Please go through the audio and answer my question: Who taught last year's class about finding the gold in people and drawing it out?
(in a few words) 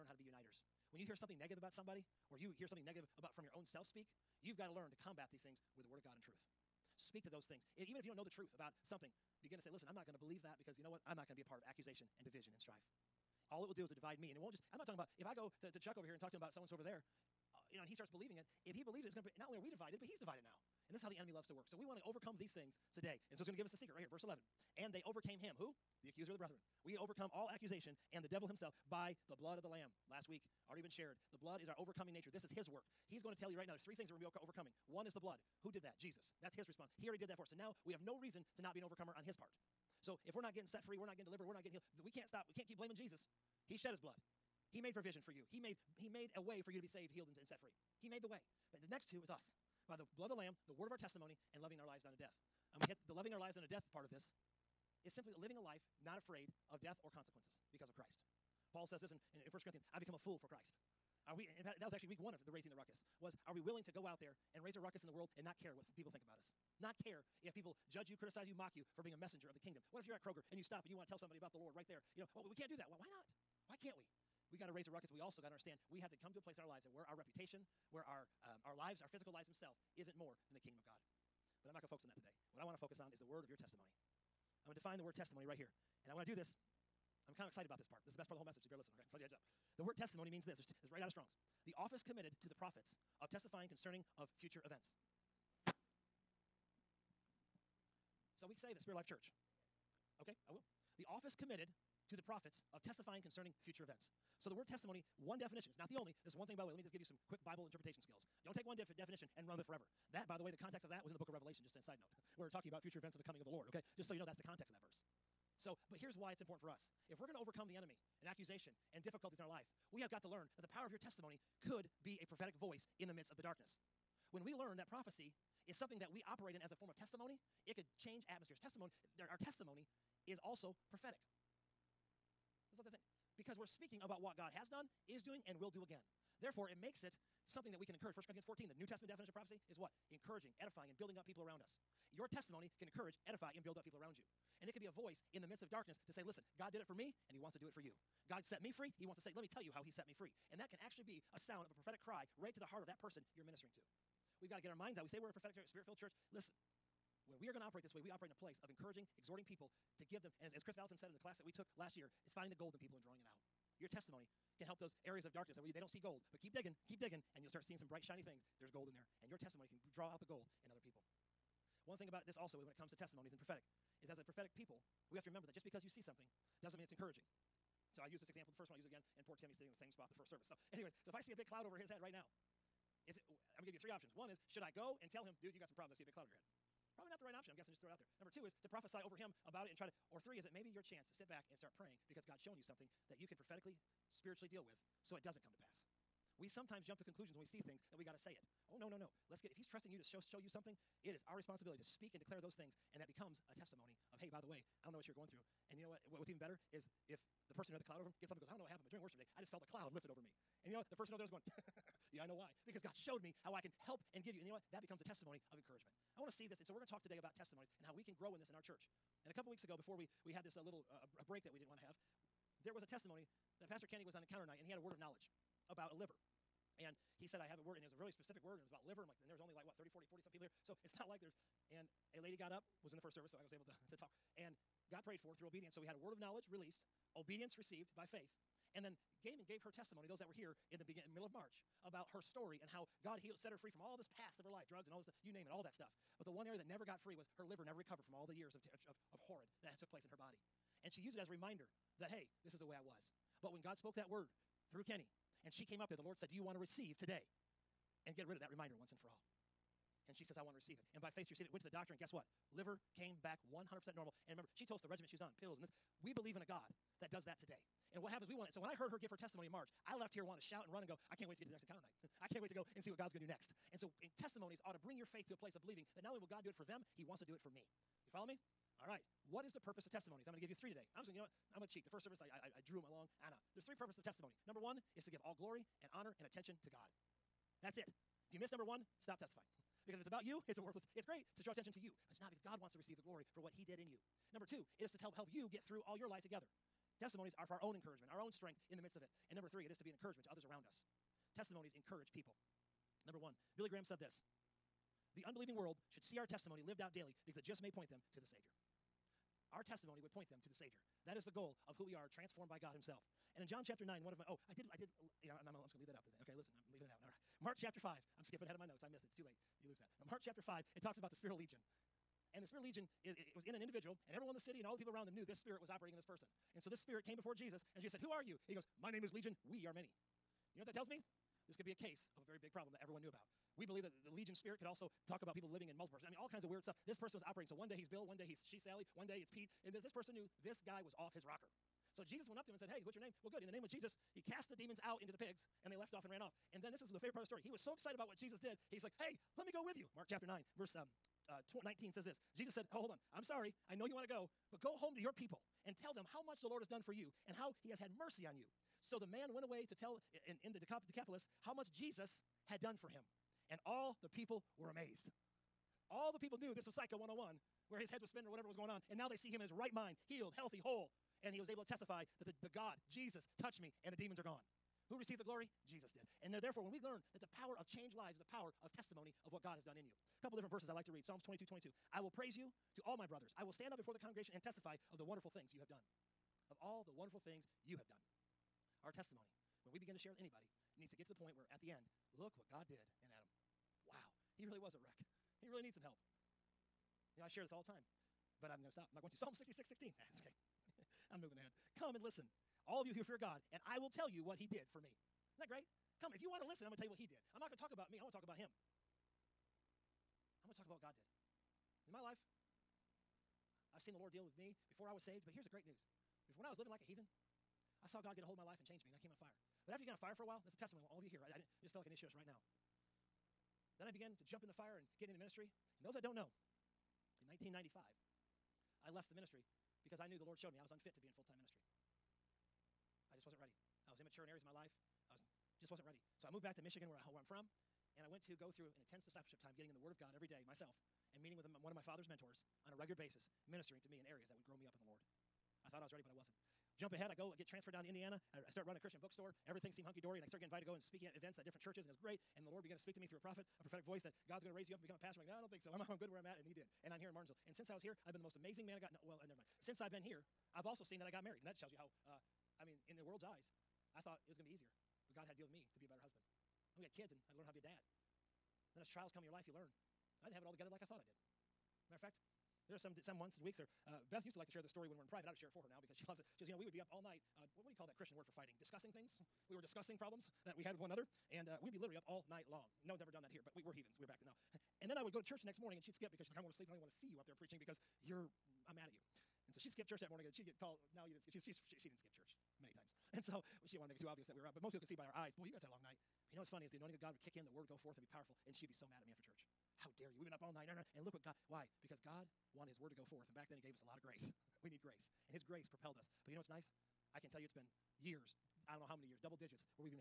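Kris Vallotton.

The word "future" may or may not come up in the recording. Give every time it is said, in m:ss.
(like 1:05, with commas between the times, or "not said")
1:34, 1:43, 1:52.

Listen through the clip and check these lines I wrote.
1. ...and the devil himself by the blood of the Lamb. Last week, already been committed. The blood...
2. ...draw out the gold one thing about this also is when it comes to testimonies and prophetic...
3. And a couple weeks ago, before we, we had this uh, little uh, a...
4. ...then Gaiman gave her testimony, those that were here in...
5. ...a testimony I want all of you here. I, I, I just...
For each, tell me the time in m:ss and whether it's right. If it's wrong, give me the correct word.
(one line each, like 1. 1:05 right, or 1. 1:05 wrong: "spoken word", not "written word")
1. 0:28 wrong: "shared", not "committed"
2. 2:49 right
3. 3:39 right
4. 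3:58 right
5. 7:00 right.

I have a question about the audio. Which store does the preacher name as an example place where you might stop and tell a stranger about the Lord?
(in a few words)
Kroger.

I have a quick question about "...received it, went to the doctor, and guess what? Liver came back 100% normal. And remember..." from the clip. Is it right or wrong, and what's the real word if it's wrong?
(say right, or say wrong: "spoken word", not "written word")
right.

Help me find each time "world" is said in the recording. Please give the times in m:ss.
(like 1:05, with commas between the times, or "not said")
1:05, 5:05, 7:43.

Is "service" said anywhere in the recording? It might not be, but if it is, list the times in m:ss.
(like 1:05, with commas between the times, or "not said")
3:00, 3:53, 4:42.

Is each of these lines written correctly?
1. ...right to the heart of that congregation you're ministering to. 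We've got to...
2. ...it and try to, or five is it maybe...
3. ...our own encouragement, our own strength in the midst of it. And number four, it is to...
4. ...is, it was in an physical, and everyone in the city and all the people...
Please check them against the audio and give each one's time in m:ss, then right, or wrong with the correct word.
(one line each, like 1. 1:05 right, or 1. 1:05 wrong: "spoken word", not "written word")
1. 2:32 wrong: "person", not "congregation"
2. 3:09 wrong: "three", not "five"
3. 4:57 wrong: "three", not "four"
4. 5:23 wrong: "individual", not "physical".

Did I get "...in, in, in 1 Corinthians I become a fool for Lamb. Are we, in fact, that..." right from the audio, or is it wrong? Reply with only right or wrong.
wrong.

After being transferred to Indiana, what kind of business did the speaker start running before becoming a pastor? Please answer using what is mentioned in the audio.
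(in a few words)
A Christian bookstore.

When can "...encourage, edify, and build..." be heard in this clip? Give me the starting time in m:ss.
2:22.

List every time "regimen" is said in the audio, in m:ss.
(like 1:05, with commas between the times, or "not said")
4:24.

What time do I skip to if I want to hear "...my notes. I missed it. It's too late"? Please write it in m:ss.
5:18.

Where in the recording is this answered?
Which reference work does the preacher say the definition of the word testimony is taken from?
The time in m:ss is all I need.
1:31.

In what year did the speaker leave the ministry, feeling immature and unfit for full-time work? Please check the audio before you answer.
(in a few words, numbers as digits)
1995.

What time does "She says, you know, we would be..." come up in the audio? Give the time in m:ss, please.
7:56.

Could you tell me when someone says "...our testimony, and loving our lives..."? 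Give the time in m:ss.
0:50.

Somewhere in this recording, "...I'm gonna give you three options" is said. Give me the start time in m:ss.
3:03.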